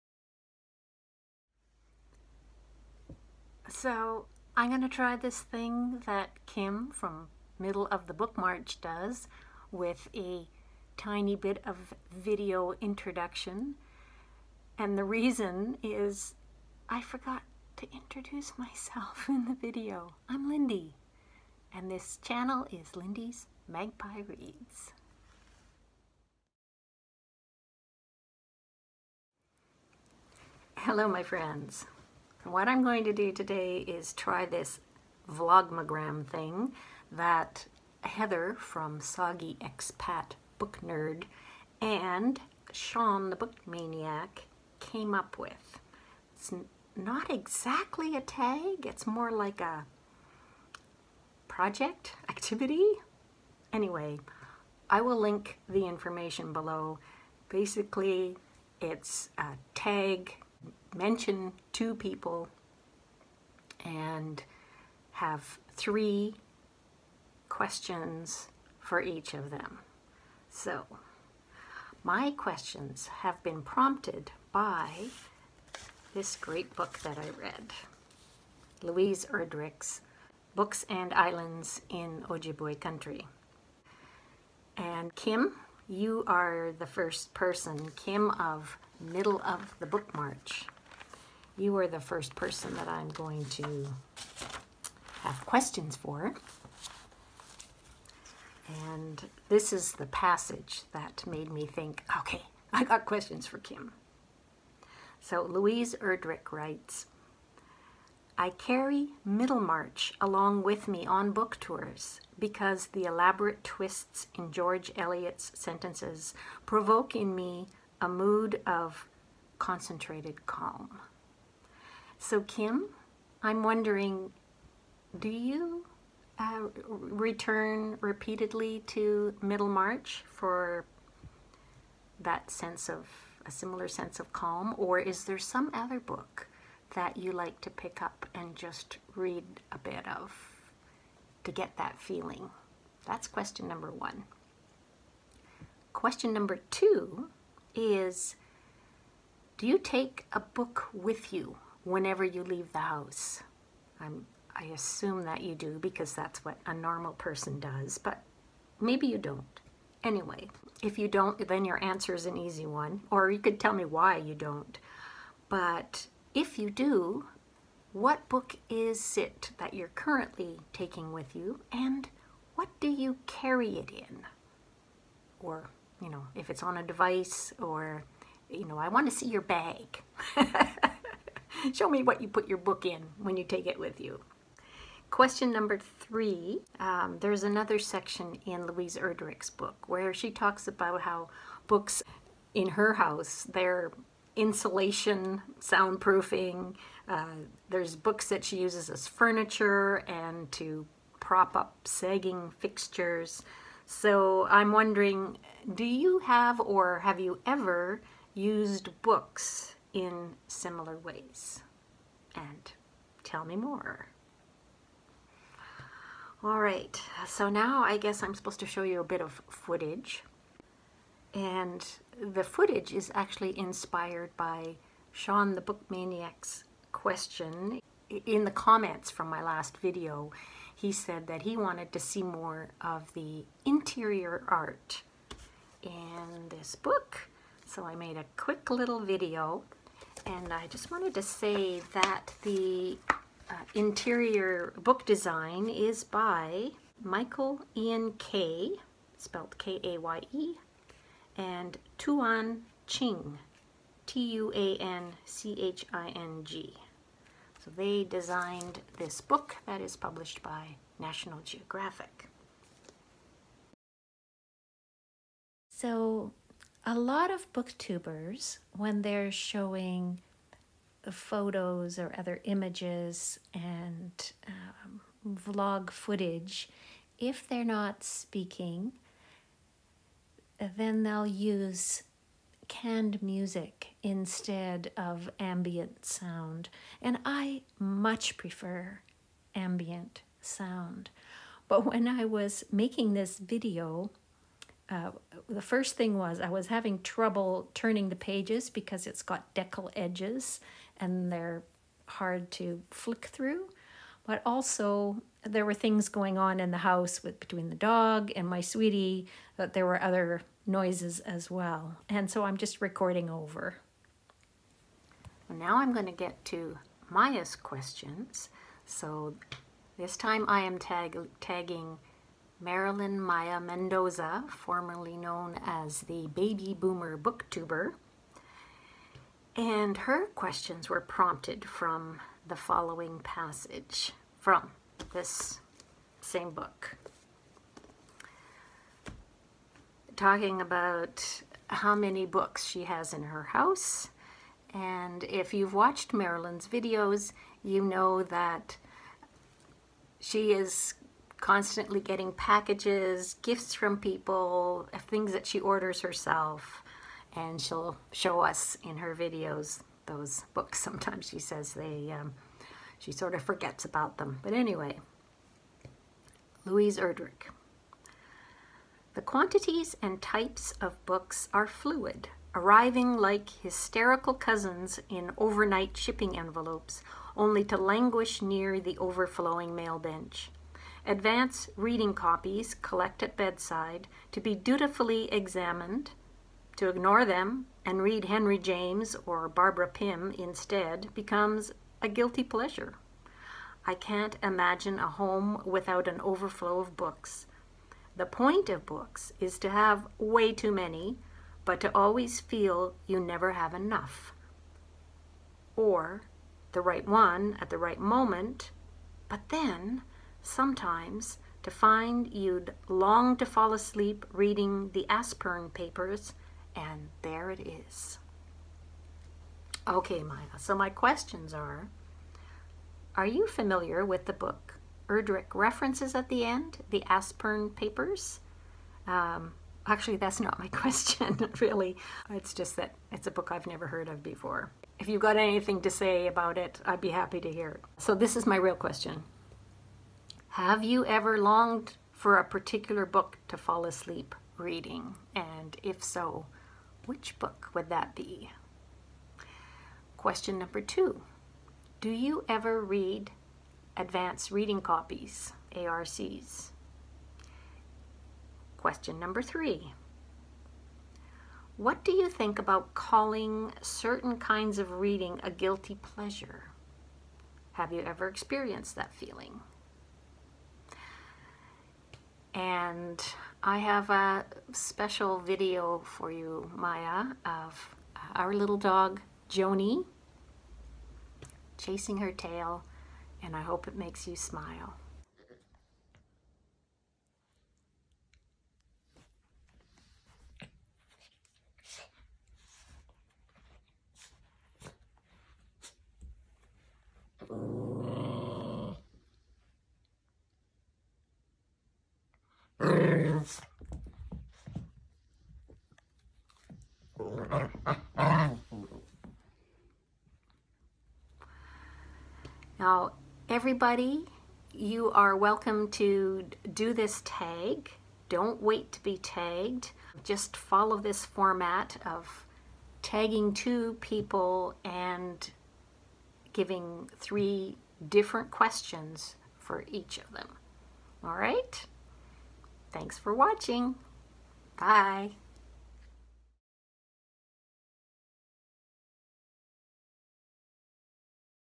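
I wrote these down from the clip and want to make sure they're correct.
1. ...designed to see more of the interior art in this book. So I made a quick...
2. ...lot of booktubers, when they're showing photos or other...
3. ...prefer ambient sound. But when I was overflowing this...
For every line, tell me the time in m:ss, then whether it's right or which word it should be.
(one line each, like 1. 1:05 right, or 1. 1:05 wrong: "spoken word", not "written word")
1. 3:51 wrong: "wanted", not "designed"
2. 4:26 right
3. 4:48 wrong: "making", not "overflowing".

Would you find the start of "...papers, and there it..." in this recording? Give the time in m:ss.
6:55.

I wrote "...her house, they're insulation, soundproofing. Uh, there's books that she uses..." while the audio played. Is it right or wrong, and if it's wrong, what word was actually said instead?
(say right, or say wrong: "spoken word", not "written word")
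right.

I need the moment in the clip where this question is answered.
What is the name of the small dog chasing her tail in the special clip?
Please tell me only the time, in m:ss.
7:59.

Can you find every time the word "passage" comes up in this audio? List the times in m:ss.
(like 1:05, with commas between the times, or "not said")
1:40, 5:33.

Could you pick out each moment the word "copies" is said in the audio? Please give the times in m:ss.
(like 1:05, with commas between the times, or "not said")
6:22, 7:34.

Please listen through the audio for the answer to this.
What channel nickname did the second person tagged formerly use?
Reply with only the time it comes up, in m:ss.
5:26.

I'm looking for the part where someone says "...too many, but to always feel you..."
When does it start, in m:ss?
6:40.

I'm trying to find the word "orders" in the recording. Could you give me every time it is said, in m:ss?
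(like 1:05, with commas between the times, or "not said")
5:55.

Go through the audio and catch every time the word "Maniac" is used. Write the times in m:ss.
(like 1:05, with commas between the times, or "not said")
0:43, 3:45.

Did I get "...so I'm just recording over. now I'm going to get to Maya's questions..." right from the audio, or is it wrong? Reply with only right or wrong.
right.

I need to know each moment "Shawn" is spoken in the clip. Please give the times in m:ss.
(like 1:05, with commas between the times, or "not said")
0:42, 3:45.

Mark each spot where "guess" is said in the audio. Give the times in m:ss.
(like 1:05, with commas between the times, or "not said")
3:37.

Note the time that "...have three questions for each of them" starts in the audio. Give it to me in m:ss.
1:05.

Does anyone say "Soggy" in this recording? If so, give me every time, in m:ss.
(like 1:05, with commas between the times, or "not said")
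0:38.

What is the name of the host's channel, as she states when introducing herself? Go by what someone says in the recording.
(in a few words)
Lindy's Magpie Reads.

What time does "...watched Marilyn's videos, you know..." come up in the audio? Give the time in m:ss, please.
5:45.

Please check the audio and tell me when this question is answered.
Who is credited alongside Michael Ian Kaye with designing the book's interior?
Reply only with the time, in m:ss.
4:11.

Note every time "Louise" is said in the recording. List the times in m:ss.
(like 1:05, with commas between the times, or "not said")
1:18, 1:45, 3:08, 6:06.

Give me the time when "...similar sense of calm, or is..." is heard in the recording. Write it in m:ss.
2:13.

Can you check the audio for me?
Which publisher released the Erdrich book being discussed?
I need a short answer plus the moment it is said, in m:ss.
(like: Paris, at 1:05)
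National Geographic, at 4:20.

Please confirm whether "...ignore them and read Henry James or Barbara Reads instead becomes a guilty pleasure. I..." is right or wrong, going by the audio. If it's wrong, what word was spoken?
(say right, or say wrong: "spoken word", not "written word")
wrong: "Pym", not "Reads".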